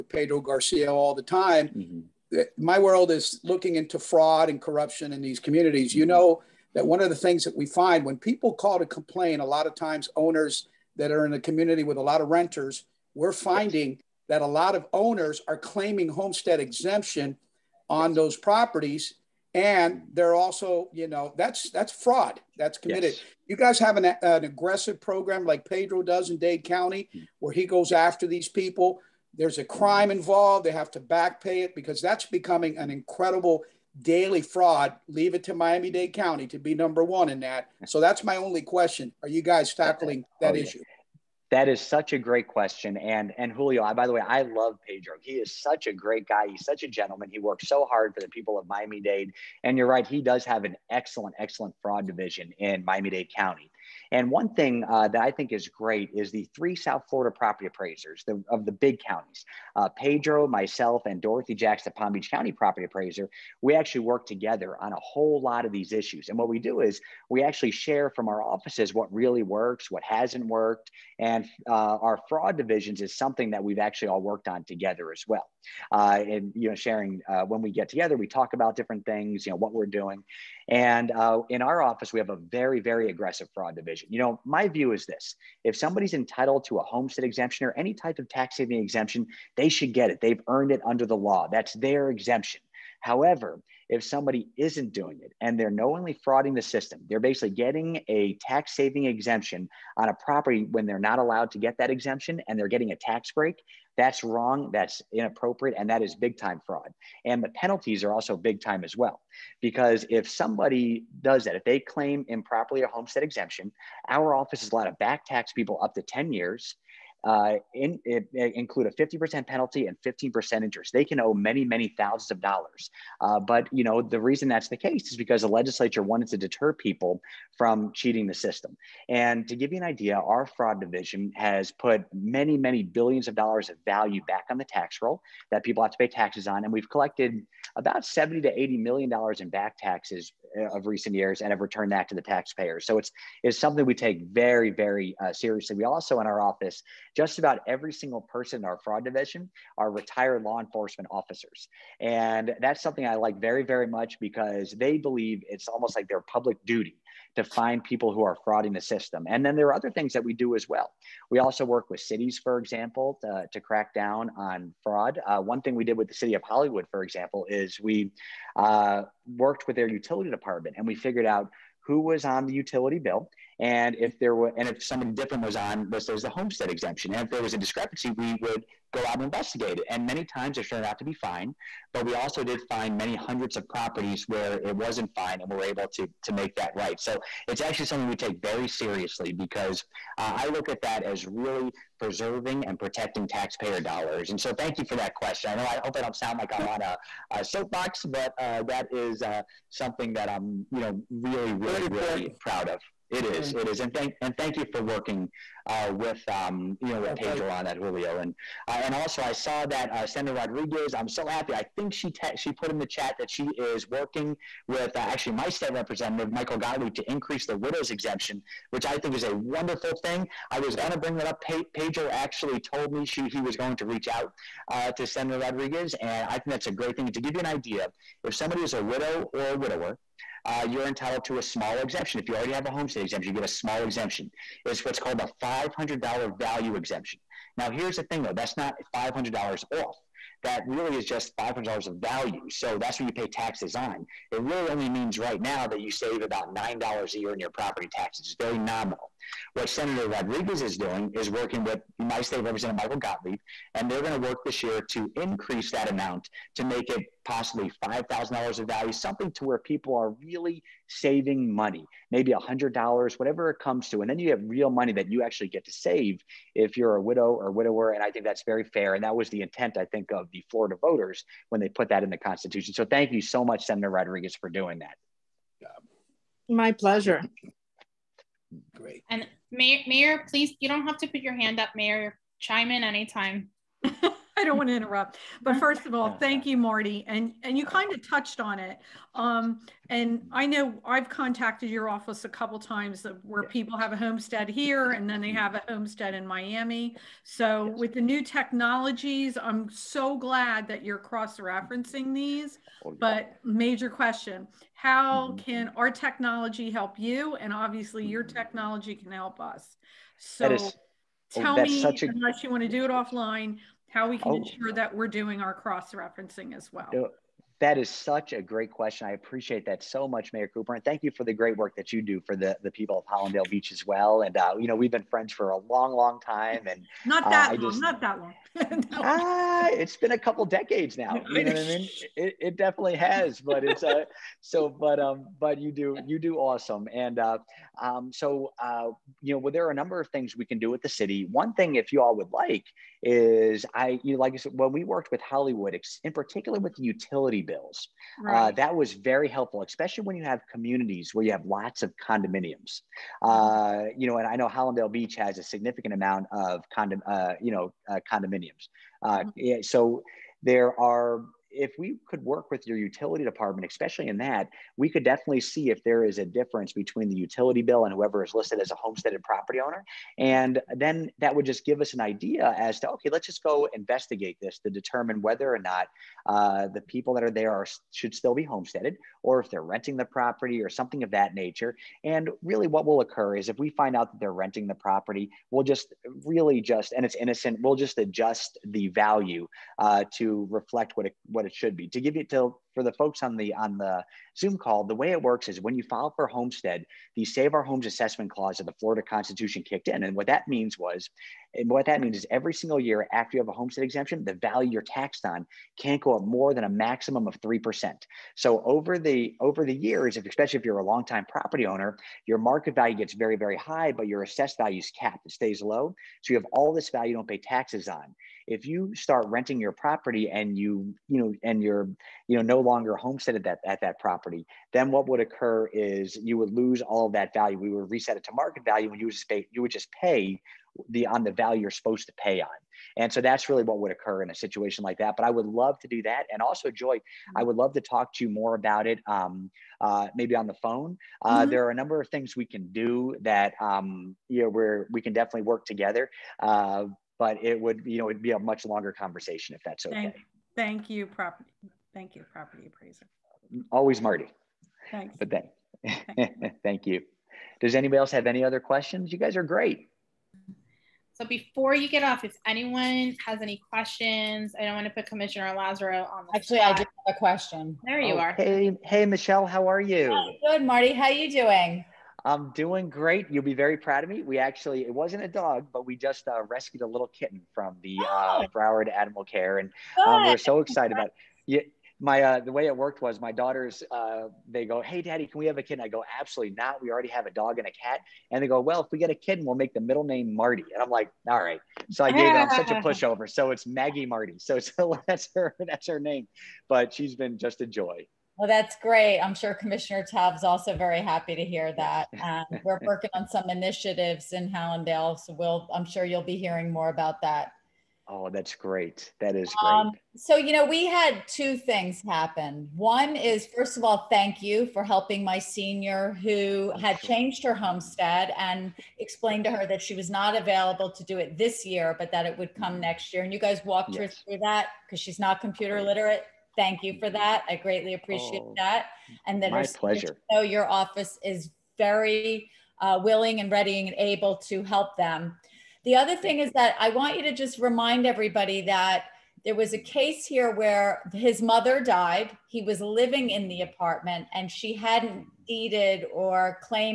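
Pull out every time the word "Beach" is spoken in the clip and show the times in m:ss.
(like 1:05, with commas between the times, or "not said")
1:02, 5:23, 5:54.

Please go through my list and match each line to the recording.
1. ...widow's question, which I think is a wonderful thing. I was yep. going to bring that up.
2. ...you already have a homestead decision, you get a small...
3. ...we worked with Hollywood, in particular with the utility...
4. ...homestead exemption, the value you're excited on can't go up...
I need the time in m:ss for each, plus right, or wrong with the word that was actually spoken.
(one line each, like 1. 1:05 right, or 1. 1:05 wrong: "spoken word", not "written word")
1. 3:37 wrong: "exemption", not "question"
2. 3:52 wrong: "exemption", not "decision"
3. 5:44 right
4. 6:43 wrong: "taxed", not "excited".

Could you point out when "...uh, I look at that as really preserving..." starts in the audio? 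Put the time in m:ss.
3:10.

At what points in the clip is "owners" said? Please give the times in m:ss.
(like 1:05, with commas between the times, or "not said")
0:10, 0:14, 6:09, 6:51.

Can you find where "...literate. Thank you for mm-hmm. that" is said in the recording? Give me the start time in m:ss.
8:45.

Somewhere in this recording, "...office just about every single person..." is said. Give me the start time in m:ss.
2:26.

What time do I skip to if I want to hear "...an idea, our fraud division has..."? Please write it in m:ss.
2:09.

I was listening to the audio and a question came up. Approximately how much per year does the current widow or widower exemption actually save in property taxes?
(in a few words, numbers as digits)
$9.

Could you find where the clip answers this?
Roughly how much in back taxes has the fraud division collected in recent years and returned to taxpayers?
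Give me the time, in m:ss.
2:18.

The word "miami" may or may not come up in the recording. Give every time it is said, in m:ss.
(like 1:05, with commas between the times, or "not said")
0:35, 0:48, 0:52, 4:56.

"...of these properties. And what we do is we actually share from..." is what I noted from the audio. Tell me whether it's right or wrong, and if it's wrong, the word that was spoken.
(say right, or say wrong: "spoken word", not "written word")
wrong: "issues", not "properties".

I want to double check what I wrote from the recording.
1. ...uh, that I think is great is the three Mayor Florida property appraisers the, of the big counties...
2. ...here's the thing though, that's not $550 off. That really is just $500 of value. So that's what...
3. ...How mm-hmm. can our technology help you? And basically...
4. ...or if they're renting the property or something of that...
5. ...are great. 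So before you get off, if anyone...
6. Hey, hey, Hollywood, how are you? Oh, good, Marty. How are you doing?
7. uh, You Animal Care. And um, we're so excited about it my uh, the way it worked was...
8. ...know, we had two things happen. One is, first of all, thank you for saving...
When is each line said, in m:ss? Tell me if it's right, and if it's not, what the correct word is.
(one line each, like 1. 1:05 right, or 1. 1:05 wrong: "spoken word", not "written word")
1. 0:54 wrong: "South", not "Mayor"
2. 3:57 wrong: "500", not "550"
3. 5:04 wrong: "obviously", not "basically"
4. 6:19 right
5. 7:39 right
6. 7:48 wrong: "Michelle", not "Hollywood"
7. 7:58 wrong: "Broward", not "You"
8. 8:30 wrong: "helping", not "saving".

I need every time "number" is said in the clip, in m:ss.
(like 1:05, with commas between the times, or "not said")
0:36, 5:39, 7:21.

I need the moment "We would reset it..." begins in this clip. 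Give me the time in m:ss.
7:07.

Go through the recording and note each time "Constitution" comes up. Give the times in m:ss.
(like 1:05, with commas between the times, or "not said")
4:32, 6:39.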